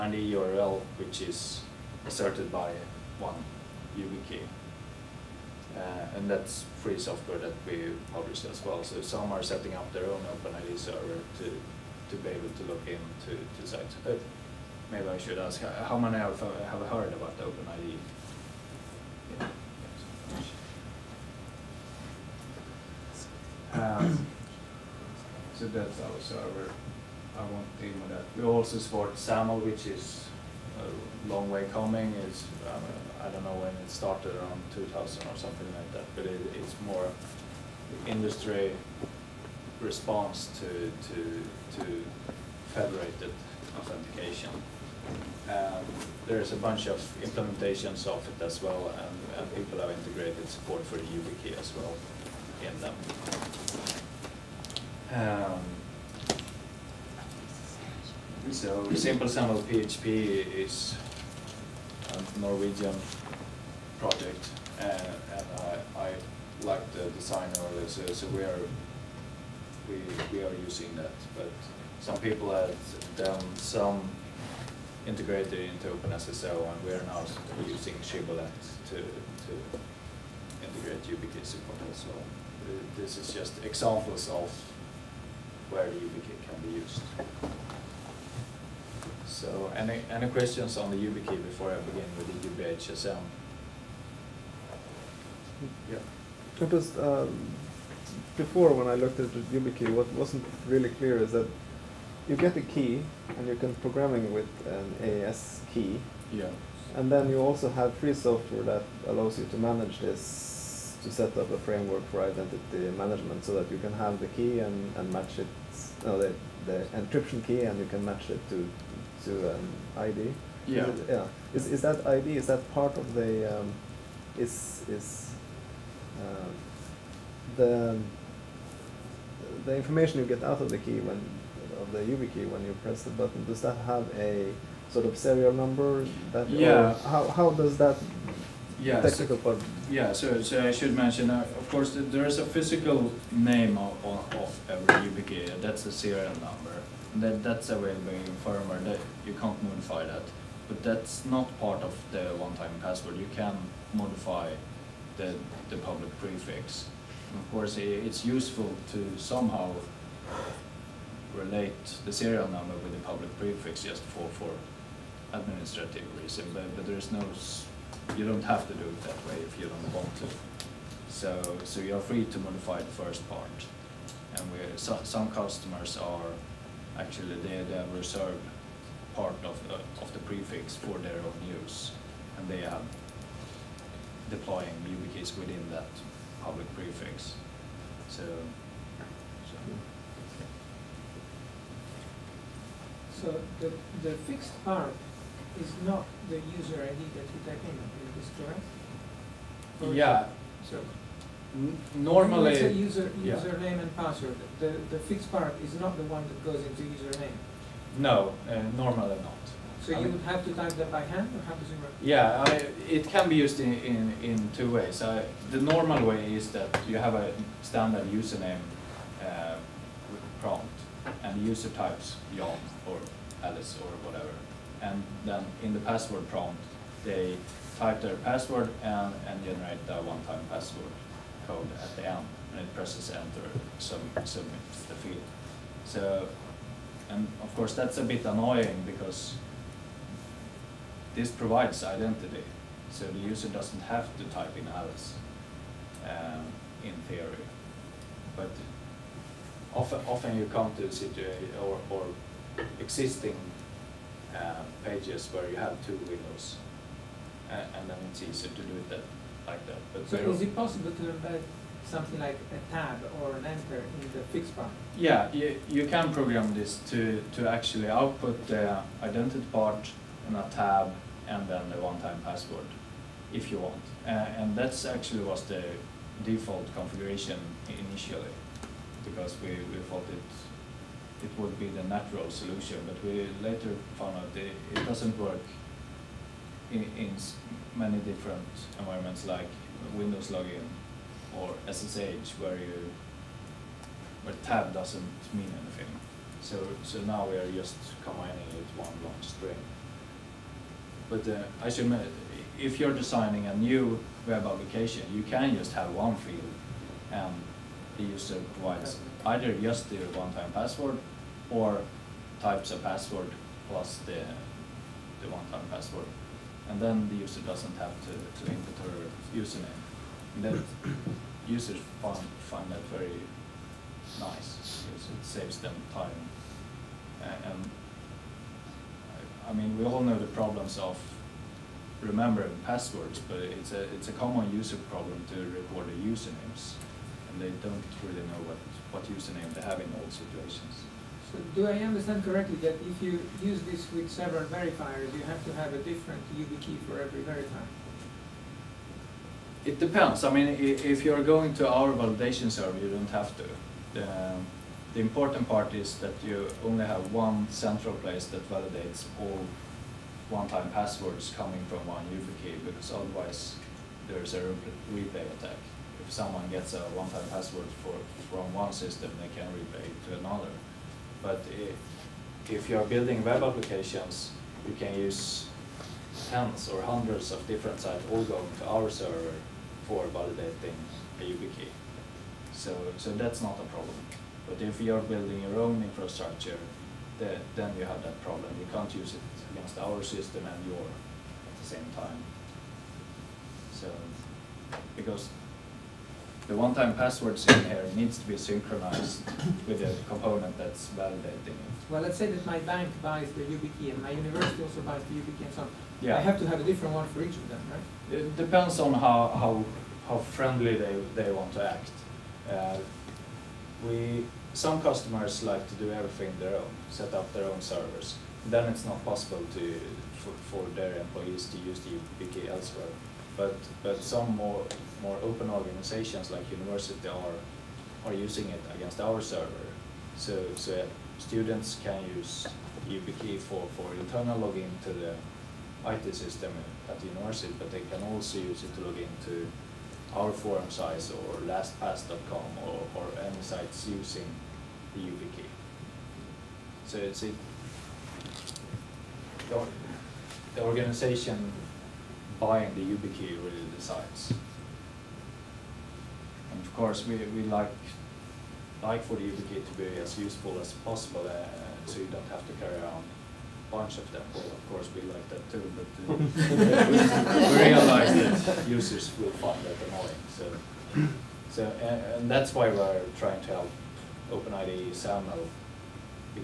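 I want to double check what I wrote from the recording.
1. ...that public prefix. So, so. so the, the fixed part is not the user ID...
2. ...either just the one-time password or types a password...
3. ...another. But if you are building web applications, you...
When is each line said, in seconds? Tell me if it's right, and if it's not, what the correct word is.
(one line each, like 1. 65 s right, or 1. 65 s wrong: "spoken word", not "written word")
1. 185 s right
2. 309 s right
3. 370 s right.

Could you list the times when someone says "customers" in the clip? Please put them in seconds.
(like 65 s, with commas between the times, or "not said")
175 s, 414 s.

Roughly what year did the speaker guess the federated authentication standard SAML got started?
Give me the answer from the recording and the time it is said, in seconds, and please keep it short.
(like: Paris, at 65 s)
2000, at 34 s.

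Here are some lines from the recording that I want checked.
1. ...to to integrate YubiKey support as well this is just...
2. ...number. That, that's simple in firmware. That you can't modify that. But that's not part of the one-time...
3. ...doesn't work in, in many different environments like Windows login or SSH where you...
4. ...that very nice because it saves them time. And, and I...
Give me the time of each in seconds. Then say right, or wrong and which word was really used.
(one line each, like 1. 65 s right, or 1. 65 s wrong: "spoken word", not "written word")
1. 78 s right
2. 146 s wrong: "available", not "simple"
3. 284 s right
4. 322 s right.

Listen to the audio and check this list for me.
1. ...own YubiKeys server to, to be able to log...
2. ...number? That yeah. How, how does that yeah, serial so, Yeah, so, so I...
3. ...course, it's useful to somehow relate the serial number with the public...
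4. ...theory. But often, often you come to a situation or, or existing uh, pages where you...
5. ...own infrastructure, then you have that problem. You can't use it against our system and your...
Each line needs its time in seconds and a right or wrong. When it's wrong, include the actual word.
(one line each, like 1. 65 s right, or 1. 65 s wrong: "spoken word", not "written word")
1. 10 s wrong: "OpenID", not "YubiKeys"
2. 135 s wrong: "technical", not "serial"
3. 157 s right
4. 247 s right
5. 385 s right.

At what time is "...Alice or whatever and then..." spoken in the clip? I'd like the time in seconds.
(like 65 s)
223 s.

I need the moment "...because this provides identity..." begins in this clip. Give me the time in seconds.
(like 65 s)
238 s.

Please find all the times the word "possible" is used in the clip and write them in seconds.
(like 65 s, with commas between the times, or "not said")
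260 s, 419 s, 460 s.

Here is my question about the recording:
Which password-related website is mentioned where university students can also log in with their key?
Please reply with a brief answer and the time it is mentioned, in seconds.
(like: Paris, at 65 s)
LastPass.com, at 441 s.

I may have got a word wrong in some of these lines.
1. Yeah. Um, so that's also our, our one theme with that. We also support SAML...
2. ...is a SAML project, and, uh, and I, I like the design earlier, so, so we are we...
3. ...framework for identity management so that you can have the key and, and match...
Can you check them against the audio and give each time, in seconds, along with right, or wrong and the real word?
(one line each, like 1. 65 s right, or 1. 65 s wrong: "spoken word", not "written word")
1. 19 s right
2. 60 s wrong: "Norwegian", not "SAML"
3. 111 s right.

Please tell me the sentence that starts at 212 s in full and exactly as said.
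Yeah, I, it can be used in in, in two ways.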